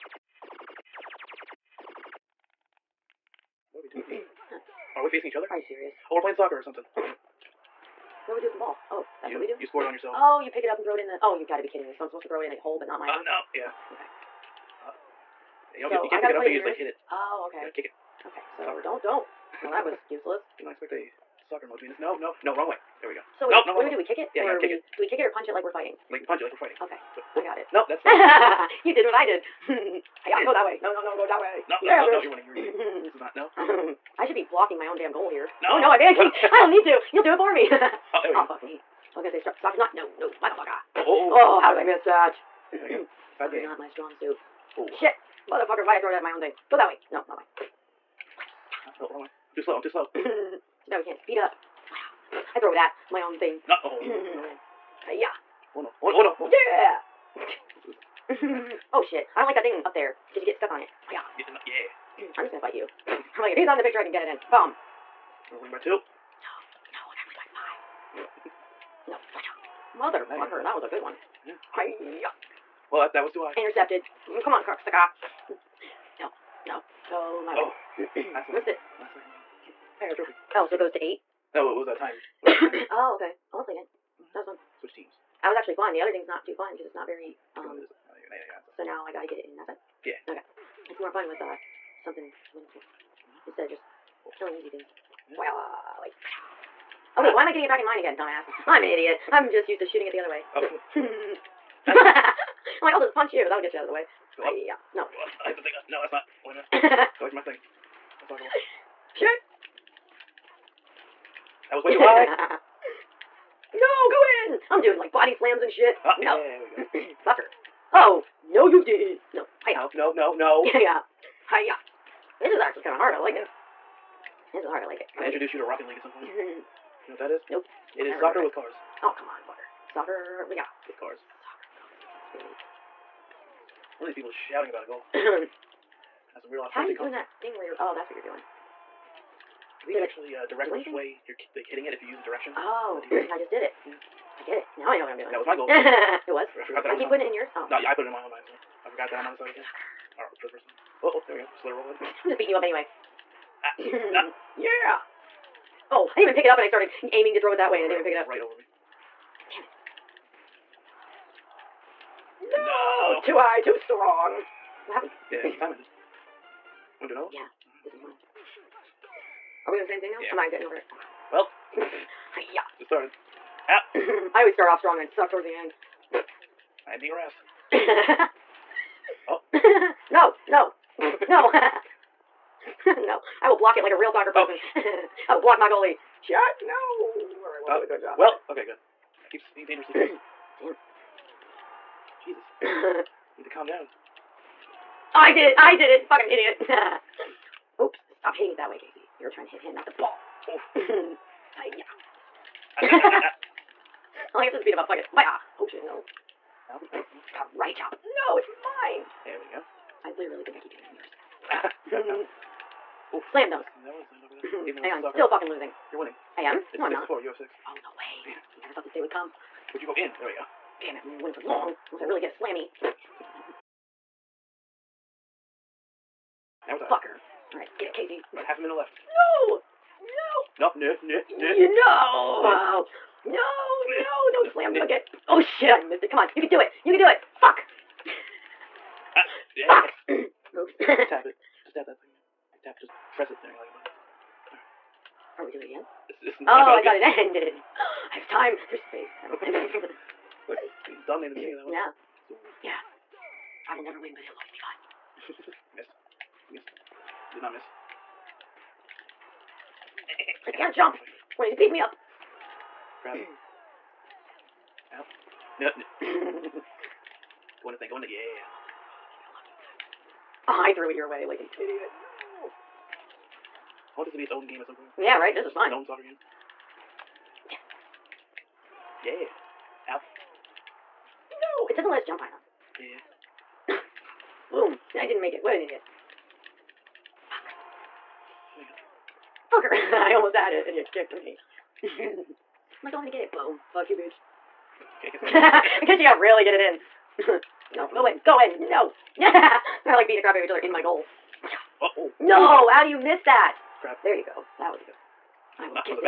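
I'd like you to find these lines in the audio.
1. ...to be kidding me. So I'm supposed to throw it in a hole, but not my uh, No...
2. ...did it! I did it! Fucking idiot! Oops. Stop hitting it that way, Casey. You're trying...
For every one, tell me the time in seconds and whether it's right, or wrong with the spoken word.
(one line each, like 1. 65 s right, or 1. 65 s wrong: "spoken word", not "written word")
1. 11 s right
2. 195 s right.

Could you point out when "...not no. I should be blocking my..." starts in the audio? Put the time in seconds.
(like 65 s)
33 s.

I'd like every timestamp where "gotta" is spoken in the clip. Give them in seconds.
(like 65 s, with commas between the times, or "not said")
67 s, 89 s.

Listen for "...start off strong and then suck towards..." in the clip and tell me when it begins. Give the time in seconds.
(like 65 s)
174 s.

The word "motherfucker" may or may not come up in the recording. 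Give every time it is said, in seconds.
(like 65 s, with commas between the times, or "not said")
40 s, 45 s, 69 s.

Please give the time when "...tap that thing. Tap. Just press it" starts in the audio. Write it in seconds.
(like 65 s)
241 s.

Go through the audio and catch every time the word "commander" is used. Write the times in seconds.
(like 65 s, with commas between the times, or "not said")
not said.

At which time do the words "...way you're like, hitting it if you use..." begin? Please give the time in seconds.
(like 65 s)
140 s.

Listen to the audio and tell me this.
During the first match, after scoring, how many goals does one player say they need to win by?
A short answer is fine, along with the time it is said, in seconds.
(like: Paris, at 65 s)
5, at 68 s.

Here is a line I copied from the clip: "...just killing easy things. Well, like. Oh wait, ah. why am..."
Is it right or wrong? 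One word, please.
right.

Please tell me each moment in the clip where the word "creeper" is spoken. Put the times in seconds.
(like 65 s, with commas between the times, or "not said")
not said.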